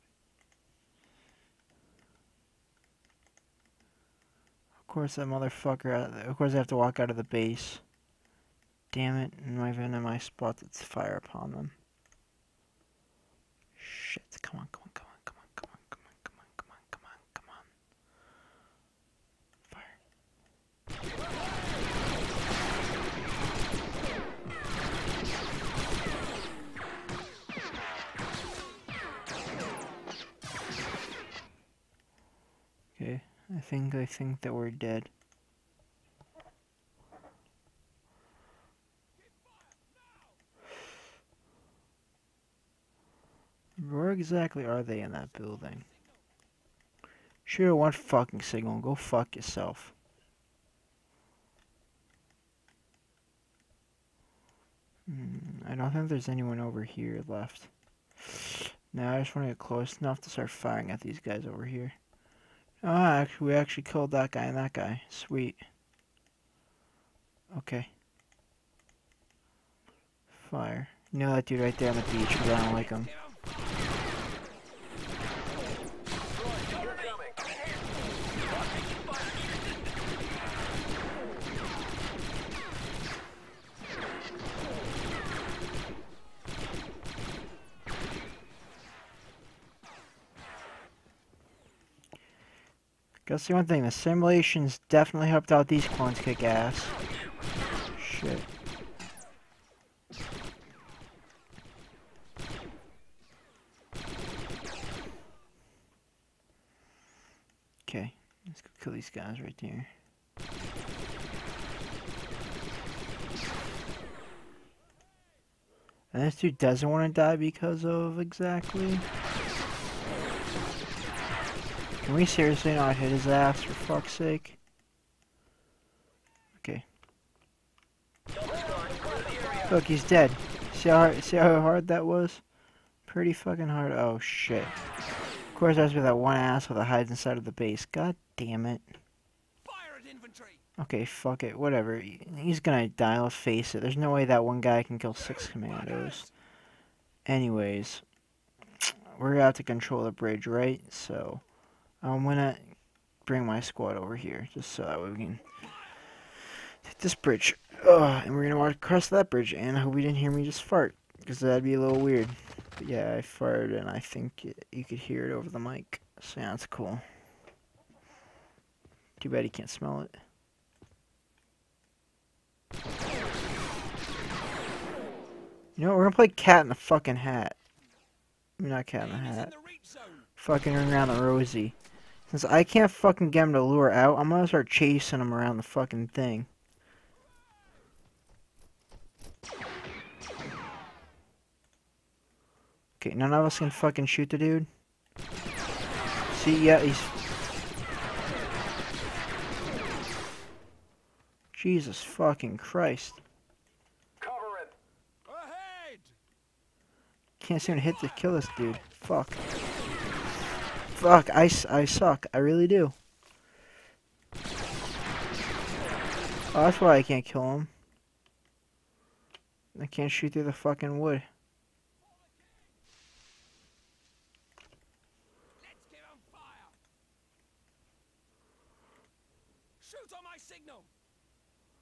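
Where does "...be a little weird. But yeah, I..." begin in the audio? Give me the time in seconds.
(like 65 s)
161 s.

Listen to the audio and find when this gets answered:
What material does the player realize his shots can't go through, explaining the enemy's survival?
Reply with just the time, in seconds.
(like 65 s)
220 s.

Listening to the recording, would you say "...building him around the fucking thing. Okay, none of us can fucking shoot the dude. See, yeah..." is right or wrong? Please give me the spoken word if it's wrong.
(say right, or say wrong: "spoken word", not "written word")
wrong: "chasing", not "building".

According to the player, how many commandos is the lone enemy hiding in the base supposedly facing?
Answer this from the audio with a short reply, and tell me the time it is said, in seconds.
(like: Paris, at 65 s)
6, at 145 s.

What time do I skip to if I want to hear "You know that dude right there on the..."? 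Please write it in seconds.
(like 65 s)
71 s.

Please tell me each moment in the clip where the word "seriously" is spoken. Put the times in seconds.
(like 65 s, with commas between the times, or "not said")
122 s.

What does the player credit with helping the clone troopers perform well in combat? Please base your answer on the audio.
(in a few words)
The simulations.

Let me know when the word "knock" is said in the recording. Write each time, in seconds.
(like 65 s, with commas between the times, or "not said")
not said.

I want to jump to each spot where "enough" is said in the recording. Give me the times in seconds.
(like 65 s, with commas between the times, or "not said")
59 s.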